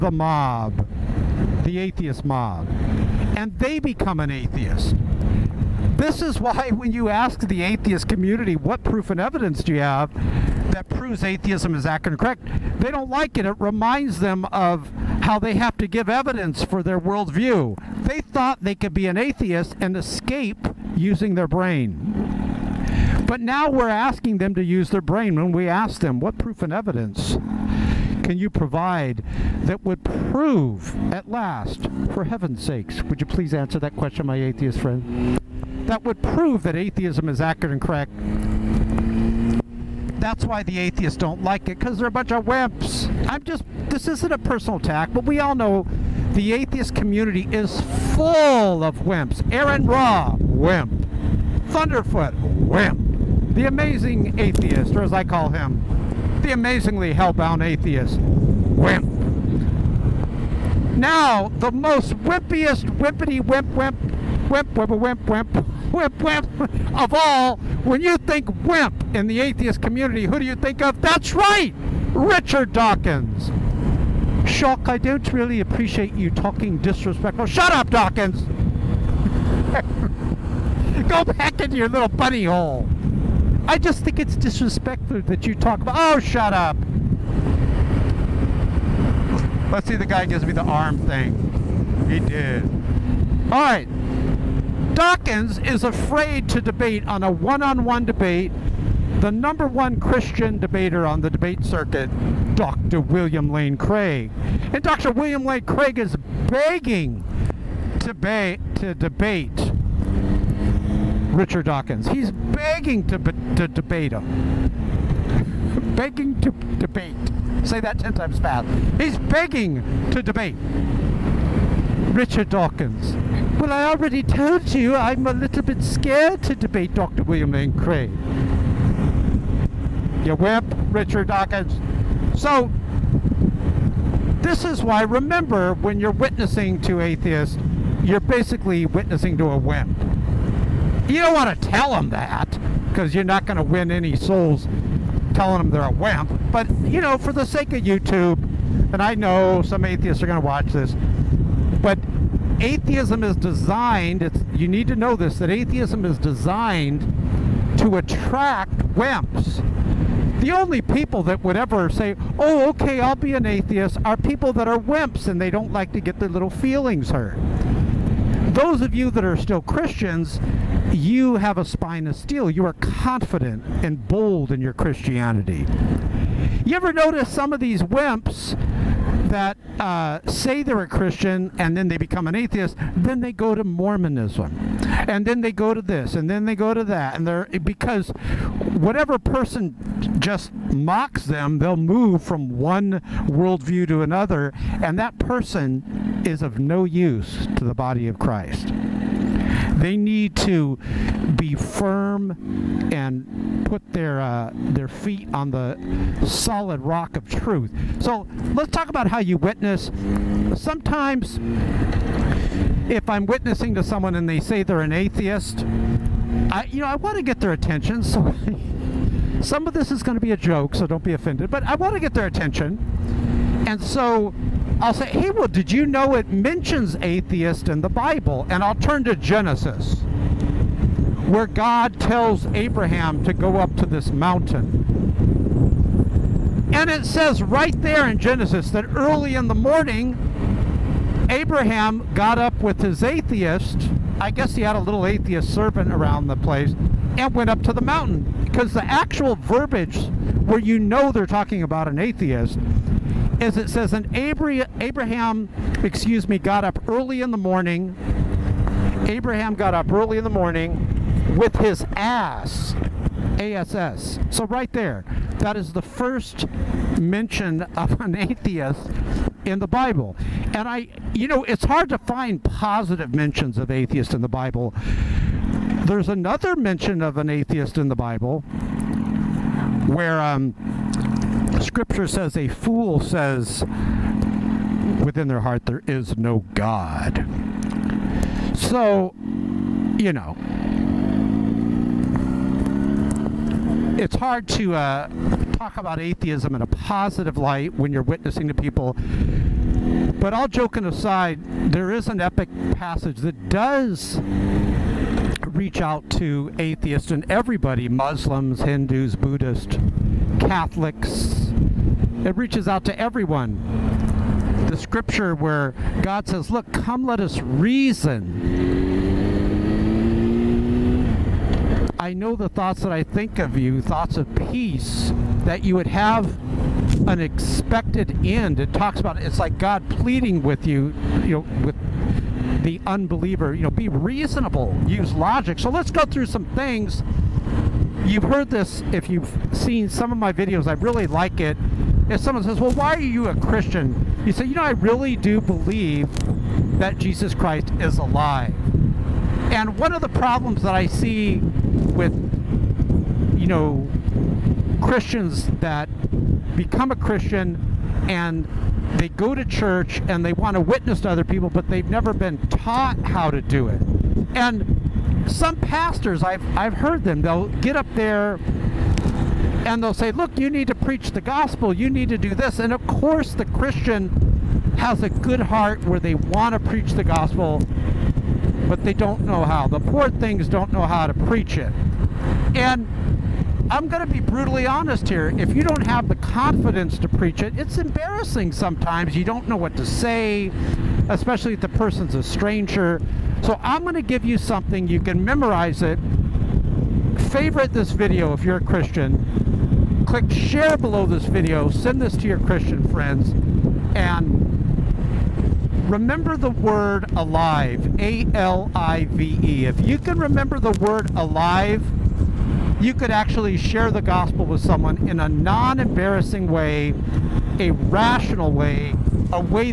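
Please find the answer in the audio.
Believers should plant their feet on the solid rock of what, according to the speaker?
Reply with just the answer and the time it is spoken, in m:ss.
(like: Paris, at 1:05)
truth, at 3:27.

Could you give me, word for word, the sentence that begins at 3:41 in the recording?
But I want to get their attention, and so I'll say, hey, well, did you know it mentions atheist in the Bible?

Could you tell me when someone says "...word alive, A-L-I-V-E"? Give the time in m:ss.
6:46.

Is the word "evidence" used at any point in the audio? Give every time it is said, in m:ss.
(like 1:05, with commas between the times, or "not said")
0:09, 0:16, 0:26.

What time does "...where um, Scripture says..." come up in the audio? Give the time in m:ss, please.
4:39.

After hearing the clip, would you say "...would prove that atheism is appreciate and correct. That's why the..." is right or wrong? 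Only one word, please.
wrong.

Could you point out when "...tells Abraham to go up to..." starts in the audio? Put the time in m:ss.
3:51.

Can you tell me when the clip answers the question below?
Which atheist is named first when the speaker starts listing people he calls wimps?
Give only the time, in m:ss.
0:49.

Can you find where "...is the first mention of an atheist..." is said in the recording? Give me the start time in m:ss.
4:25.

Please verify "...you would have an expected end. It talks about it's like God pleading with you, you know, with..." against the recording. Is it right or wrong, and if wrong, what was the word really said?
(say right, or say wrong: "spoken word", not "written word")
right.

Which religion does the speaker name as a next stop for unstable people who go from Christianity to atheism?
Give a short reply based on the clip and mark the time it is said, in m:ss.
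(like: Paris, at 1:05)
Mormonism, at 3:03.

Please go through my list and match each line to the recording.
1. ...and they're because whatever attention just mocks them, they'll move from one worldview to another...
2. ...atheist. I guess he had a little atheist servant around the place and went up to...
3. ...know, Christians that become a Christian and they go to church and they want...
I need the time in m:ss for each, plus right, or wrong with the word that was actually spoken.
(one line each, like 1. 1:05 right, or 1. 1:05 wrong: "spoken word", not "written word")
1. 3:07 wrong: "person", not "attention"
2. 4:03 right
3. 5:53 right.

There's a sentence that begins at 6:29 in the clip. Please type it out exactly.
You don't know what to say, especially if the person's a stranger.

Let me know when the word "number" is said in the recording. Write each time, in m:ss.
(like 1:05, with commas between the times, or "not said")
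1:39.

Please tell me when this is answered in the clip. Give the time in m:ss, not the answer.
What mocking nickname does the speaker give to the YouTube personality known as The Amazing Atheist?
0:56.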